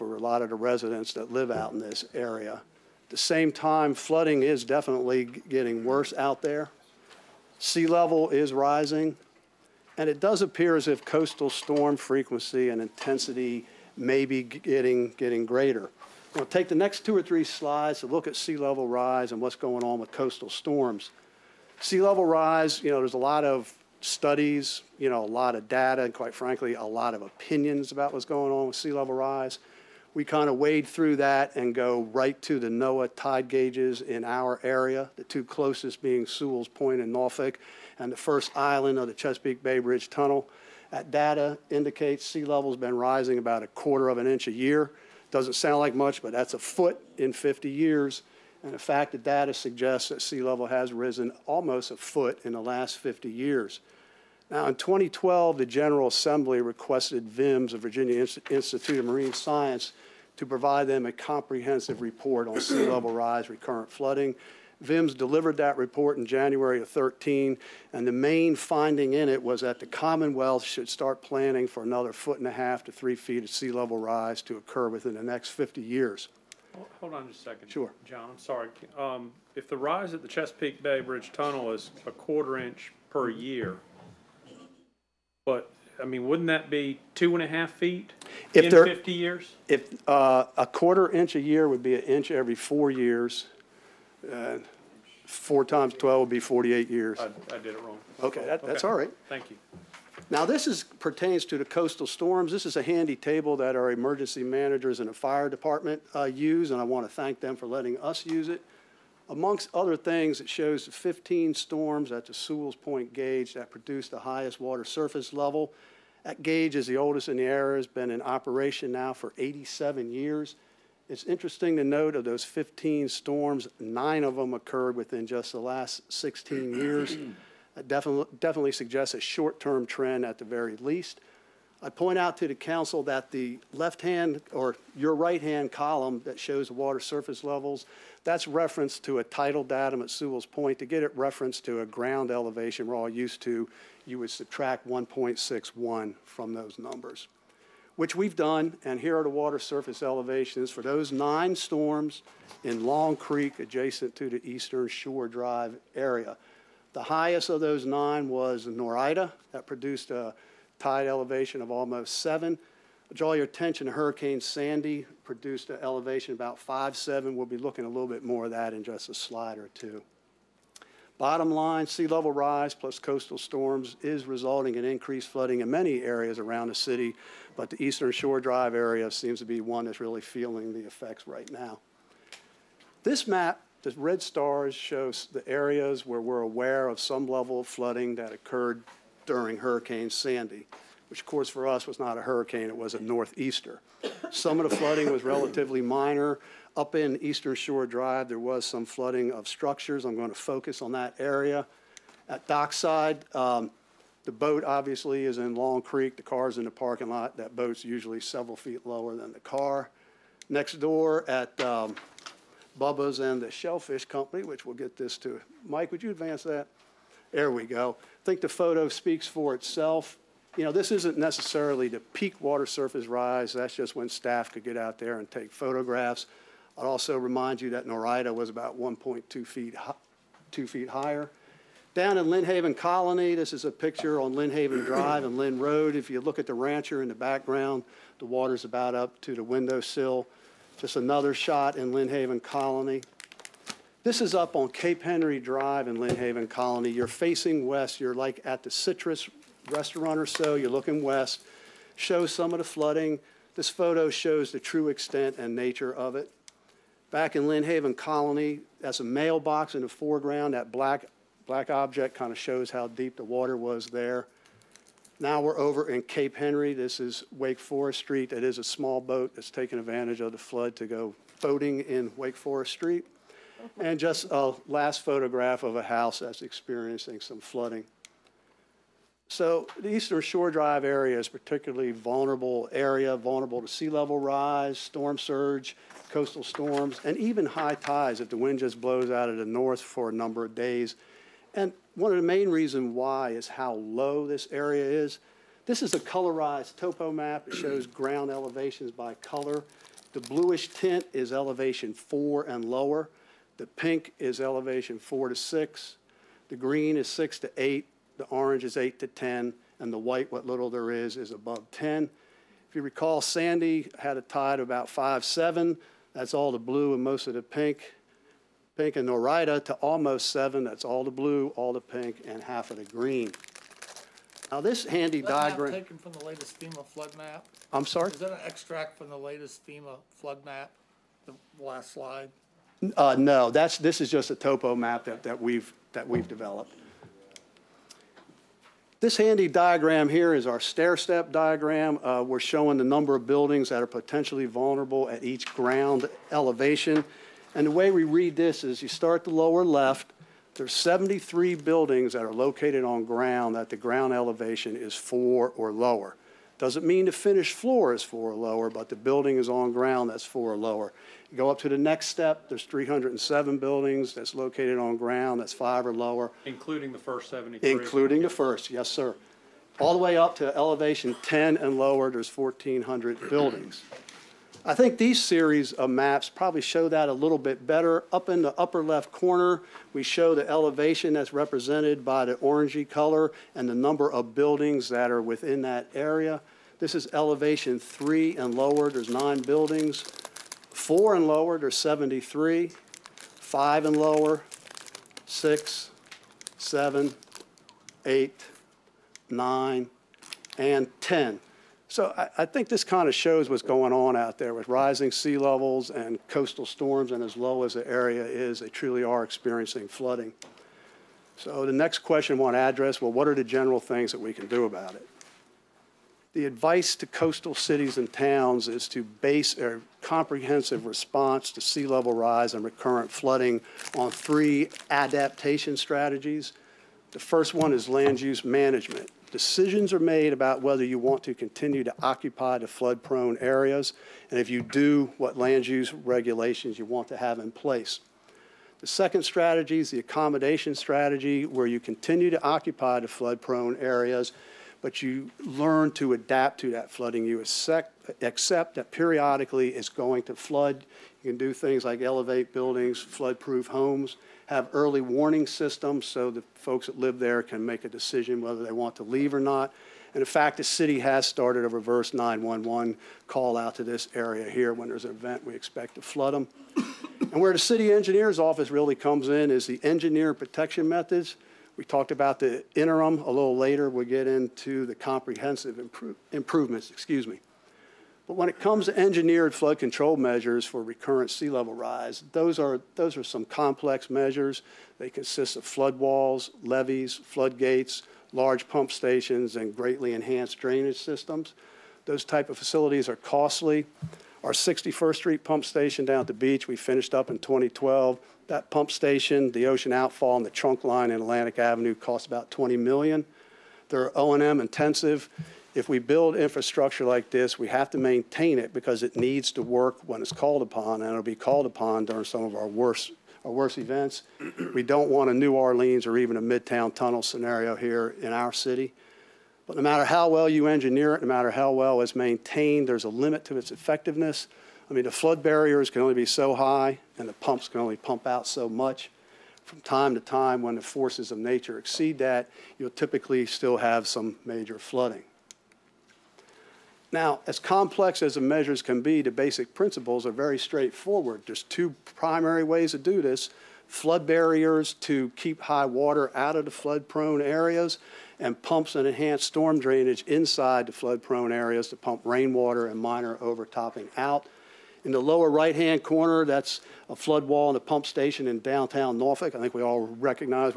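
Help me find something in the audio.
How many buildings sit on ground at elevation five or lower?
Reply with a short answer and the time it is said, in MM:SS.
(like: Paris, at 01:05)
307, at 06:02.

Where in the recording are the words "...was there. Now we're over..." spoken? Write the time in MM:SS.
04:23.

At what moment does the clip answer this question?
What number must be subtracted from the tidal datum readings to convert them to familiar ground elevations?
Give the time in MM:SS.
02:24.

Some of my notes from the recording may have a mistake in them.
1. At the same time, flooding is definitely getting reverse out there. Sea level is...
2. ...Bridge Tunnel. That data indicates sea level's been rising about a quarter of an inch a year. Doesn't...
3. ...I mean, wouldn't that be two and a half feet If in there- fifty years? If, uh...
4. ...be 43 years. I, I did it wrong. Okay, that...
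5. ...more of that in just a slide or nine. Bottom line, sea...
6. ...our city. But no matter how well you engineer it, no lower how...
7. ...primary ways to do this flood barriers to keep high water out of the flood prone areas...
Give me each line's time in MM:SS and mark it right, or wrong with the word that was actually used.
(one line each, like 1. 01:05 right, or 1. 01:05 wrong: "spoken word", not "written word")
1. 00:03 wrong: "worse", not "reverse"
2. 00:39 right
3. 01:26 right
4. 01:36 wrong: "48", not "43"
5. 02:48 wrong: "two", not "nine"
6. 08:38 wrong: "matter", not "lower"
7. 09:02 right.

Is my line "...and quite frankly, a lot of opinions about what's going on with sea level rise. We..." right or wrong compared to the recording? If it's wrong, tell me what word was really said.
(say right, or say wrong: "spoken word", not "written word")
right.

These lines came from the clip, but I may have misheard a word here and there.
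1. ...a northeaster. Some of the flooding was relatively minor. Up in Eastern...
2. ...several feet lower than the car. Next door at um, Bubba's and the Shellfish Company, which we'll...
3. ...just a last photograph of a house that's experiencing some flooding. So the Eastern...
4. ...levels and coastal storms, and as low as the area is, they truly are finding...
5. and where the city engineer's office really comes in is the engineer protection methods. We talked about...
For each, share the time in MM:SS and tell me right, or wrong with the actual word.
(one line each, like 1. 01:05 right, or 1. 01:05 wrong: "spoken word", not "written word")
1. 03:12 right
2. 03:28 right
3. 04:33 right
4. 06:45 wrong: "experiencing", not "finding"
5. 07:47 right.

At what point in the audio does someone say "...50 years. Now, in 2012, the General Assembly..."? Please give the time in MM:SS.
00:52.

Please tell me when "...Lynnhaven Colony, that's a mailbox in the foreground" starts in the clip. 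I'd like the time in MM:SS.
04:17.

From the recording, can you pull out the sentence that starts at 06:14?
I think these series of maps probably show that a little bit better.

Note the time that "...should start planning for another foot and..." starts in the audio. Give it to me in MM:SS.
01:10.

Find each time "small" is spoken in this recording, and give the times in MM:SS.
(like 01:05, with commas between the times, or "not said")
04:28.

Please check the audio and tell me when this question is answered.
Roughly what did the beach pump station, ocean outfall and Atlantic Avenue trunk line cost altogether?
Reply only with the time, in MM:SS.
08:22.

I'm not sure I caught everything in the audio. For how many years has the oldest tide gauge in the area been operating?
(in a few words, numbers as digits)
87 years.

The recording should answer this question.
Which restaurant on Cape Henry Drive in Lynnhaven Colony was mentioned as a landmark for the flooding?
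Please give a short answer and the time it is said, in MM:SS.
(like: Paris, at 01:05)
Citrus, at 04:08.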